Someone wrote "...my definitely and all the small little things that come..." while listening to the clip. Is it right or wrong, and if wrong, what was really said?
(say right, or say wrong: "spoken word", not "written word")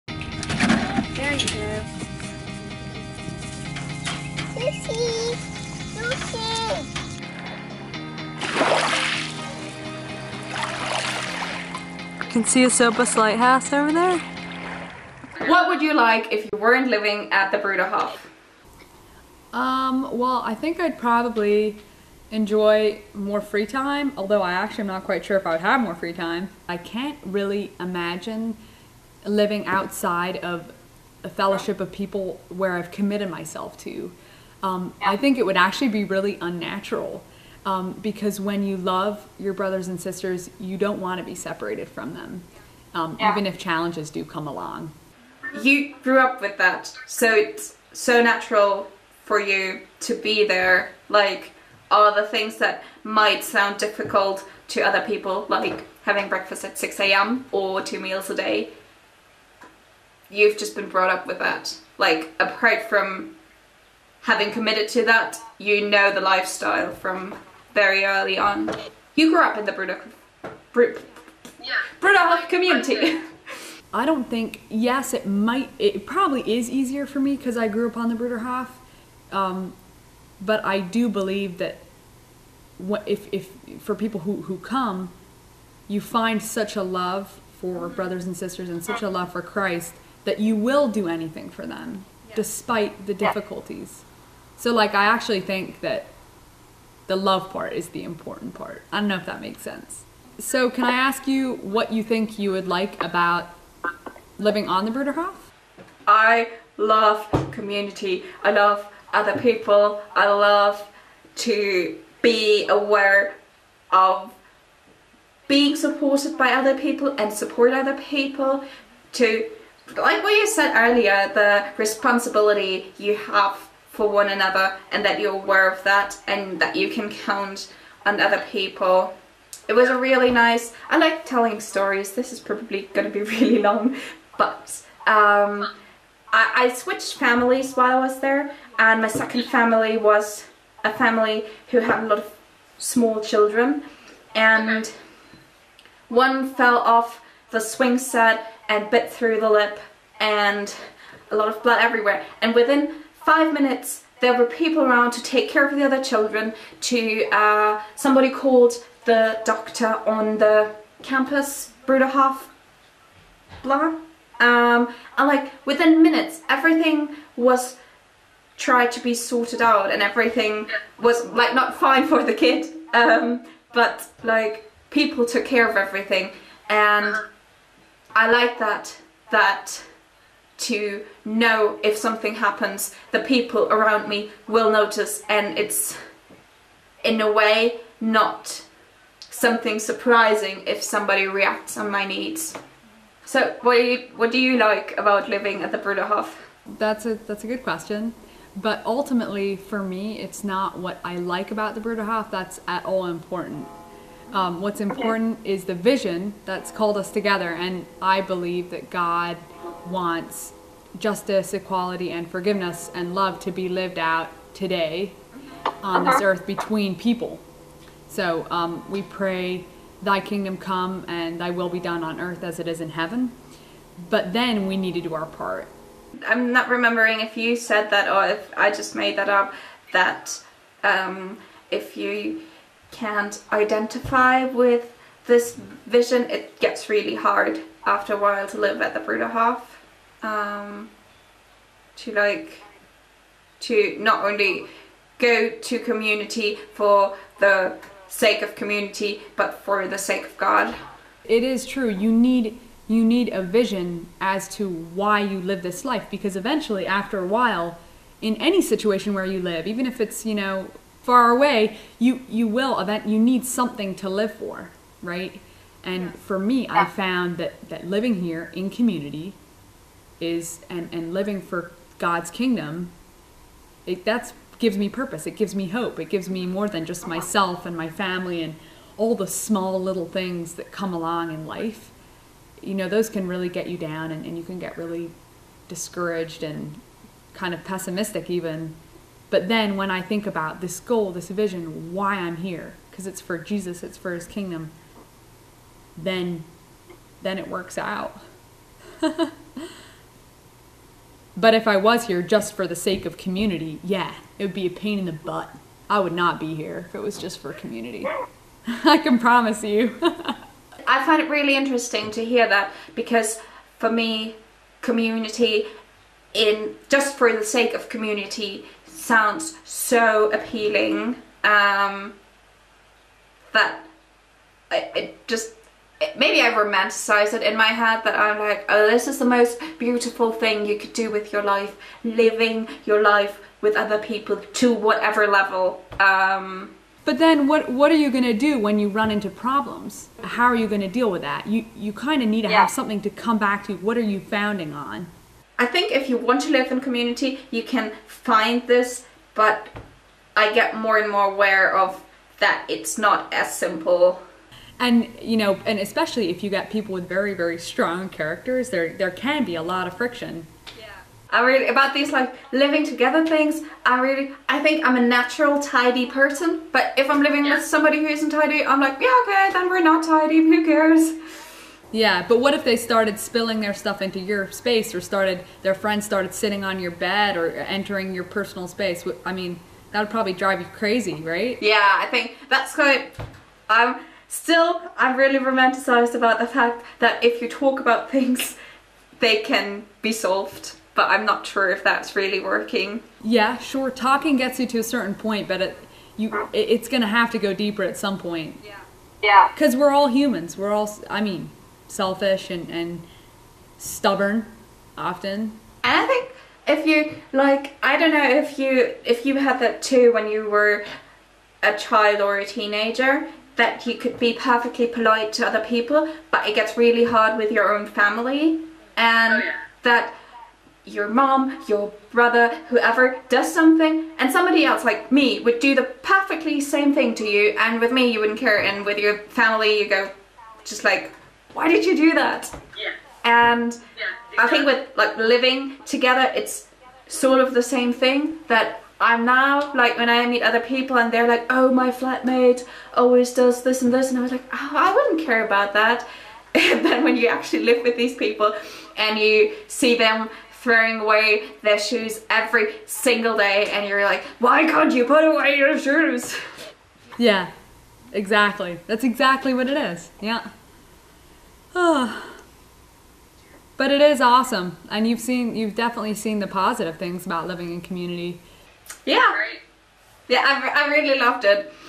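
wrong: "family", not "definitely".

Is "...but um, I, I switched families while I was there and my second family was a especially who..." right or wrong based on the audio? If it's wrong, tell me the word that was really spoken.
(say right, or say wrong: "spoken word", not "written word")
wrong: "family", not "especially".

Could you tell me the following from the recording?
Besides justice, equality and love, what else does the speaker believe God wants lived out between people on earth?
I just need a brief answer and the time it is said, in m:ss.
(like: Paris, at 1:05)
Forgiveness, at 3:32.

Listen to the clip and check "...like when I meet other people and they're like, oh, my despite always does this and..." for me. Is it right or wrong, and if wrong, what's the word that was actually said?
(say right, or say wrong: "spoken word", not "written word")
wrong: "flatmate", not "despite".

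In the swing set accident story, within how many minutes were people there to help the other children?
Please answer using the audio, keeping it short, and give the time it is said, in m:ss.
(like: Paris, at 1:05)
5, at 2:33.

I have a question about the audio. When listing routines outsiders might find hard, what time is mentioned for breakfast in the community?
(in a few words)
6 a.m.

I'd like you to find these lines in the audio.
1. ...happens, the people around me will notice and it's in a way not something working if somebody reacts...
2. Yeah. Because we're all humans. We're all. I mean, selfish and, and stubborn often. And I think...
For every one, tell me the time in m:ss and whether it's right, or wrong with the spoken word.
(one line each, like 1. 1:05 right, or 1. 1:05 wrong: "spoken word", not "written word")
1. 3:02 wrong: "surprising", not "working"
2. 6:39 right.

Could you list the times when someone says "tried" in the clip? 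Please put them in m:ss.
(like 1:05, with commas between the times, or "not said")
2:48.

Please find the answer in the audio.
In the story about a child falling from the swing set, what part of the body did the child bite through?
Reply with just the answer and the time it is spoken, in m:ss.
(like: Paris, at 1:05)
Lip, at 2:29.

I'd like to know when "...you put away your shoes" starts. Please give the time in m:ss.
7:34.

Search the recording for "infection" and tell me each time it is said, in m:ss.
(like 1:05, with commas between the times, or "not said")
not said.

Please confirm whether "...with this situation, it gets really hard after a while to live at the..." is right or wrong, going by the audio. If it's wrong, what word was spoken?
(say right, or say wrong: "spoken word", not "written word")
wrong: "vision", not "situation".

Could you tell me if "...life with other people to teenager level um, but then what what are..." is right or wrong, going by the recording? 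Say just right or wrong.
wrong.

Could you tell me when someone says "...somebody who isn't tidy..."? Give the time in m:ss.
6:07.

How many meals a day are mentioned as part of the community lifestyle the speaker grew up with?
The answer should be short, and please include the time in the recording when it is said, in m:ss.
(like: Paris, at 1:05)
2, at 0:57.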